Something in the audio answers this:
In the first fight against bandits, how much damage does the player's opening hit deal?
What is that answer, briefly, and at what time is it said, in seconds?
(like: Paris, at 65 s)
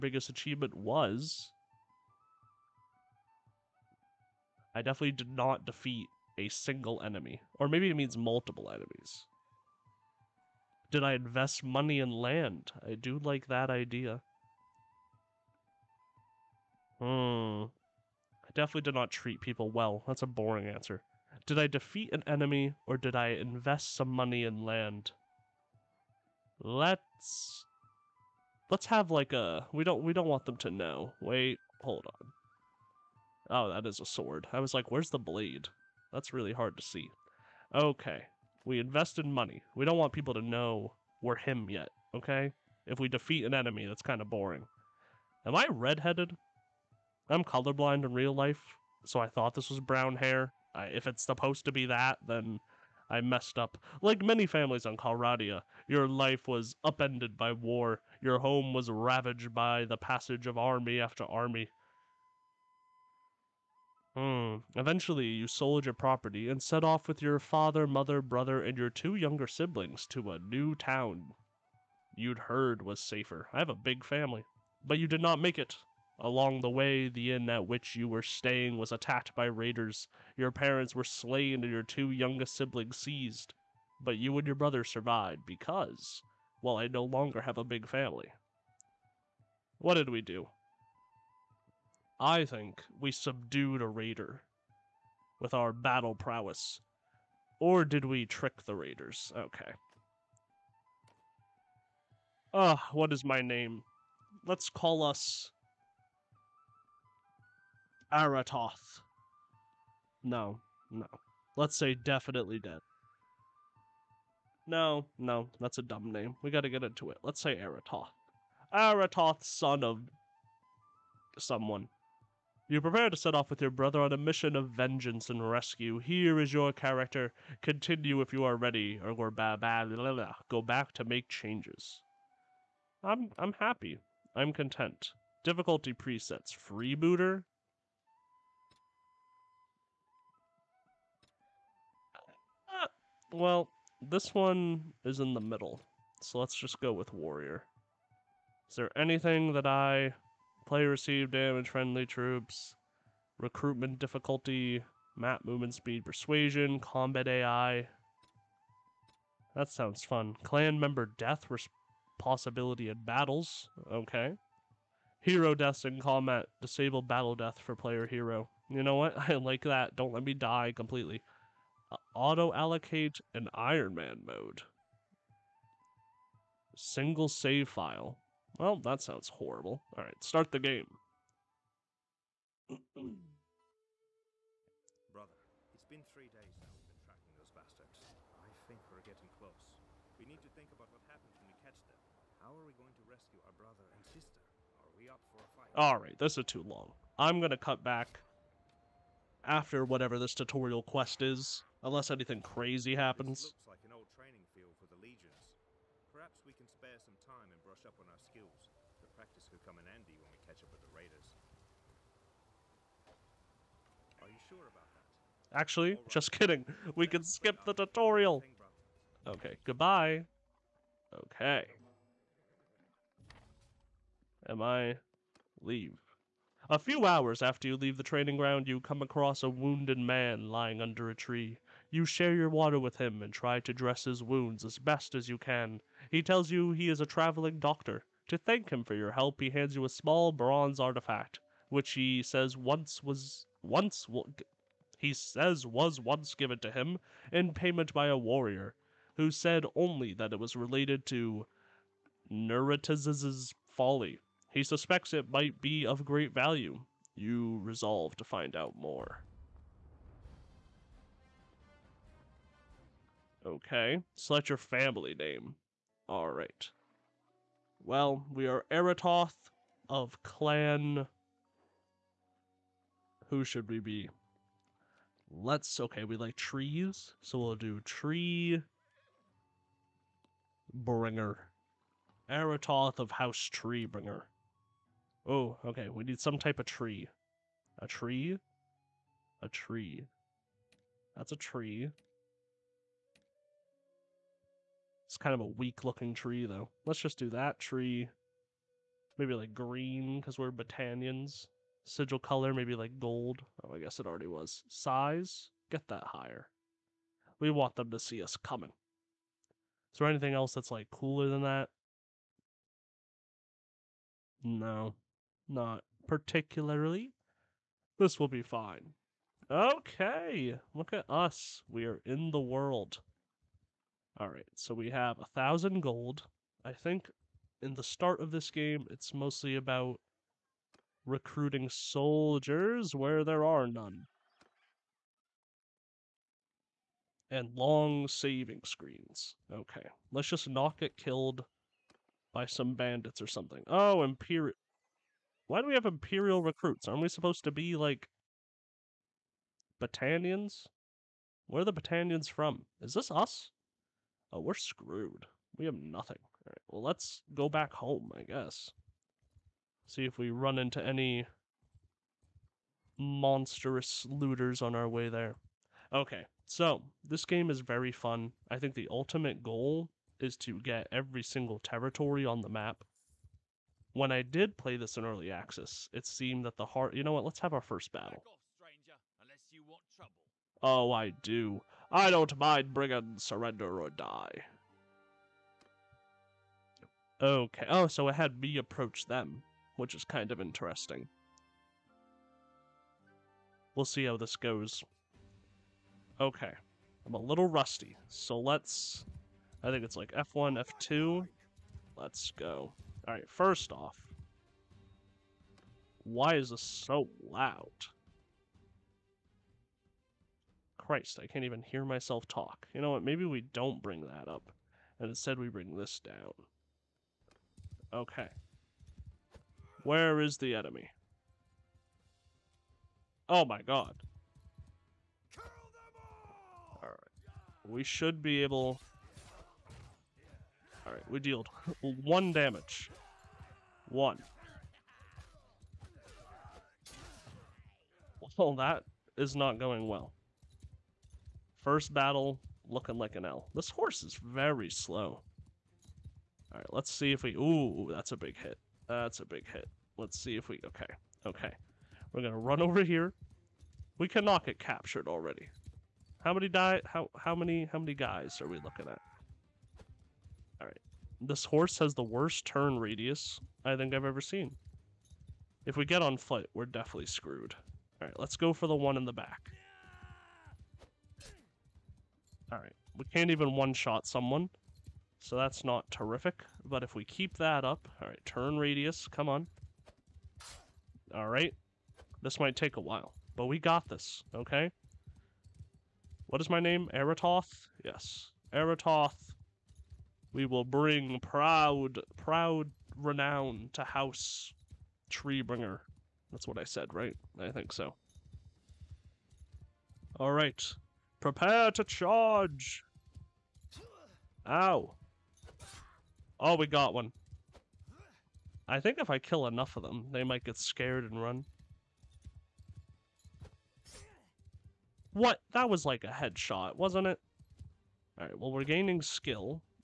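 1, at 432 s.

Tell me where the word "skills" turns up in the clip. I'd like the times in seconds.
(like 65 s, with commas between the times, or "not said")
208 s, 519 s.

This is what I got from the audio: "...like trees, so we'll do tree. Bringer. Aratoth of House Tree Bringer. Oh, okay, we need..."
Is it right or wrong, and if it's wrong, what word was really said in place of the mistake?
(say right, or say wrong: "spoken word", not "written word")
right.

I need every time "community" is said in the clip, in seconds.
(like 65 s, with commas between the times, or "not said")
not said.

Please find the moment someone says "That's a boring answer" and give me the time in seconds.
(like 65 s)
20 s.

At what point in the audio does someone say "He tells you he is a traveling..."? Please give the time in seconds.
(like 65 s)
236 s.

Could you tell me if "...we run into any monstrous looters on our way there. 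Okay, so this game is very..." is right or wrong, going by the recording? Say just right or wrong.
right.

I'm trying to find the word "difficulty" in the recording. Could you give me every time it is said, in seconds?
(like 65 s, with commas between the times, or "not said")
135 s, 153 s.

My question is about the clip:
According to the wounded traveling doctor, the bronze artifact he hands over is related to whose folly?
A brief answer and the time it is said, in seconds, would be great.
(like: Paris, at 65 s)
Neretzes, at 252 s.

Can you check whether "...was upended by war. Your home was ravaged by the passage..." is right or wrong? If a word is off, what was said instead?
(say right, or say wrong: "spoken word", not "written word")
right.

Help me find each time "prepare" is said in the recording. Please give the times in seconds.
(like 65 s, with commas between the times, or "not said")
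122 s, 501 s.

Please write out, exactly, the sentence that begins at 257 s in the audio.
You resolve to find out more.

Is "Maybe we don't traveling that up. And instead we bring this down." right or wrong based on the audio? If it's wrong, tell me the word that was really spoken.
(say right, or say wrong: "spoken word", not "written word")
wrong: "bring", not "traveling".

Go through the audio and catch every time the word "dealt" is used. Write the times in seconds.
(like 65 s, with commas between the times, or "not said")
431 s.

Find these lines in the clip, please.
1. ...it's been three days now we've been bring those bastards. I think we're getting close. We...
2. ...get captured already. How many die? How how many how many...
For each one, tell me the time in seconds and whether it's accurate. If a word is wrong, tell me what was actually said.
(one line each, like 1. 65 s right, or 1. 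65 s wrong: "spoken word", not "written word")
1. 185 s wrong: "tracking", not "bring"
2. 454 s right.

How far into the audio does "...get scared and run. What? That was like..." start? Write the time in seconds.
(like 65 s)
510 s.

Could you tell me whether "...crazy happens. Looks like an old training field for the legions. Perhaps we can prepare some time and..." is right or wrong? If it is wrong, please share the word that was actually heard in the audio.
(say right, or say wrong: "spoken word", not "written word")
wrong: "spare", not "prepare".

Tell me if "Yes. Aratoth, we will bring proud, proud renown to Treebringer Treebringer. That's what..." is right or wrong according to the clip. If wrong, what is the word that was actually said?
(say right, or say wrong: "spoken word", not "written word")
wrong: "House", not "Treebringer".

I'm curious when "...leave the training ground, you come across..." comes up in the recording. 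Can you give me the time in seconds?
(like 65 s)
227 s.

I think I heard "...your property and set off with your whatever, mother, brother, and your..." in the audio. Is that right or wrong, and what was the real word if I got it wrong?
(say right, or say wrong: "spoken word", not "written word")
wrong: "father", not "whatever".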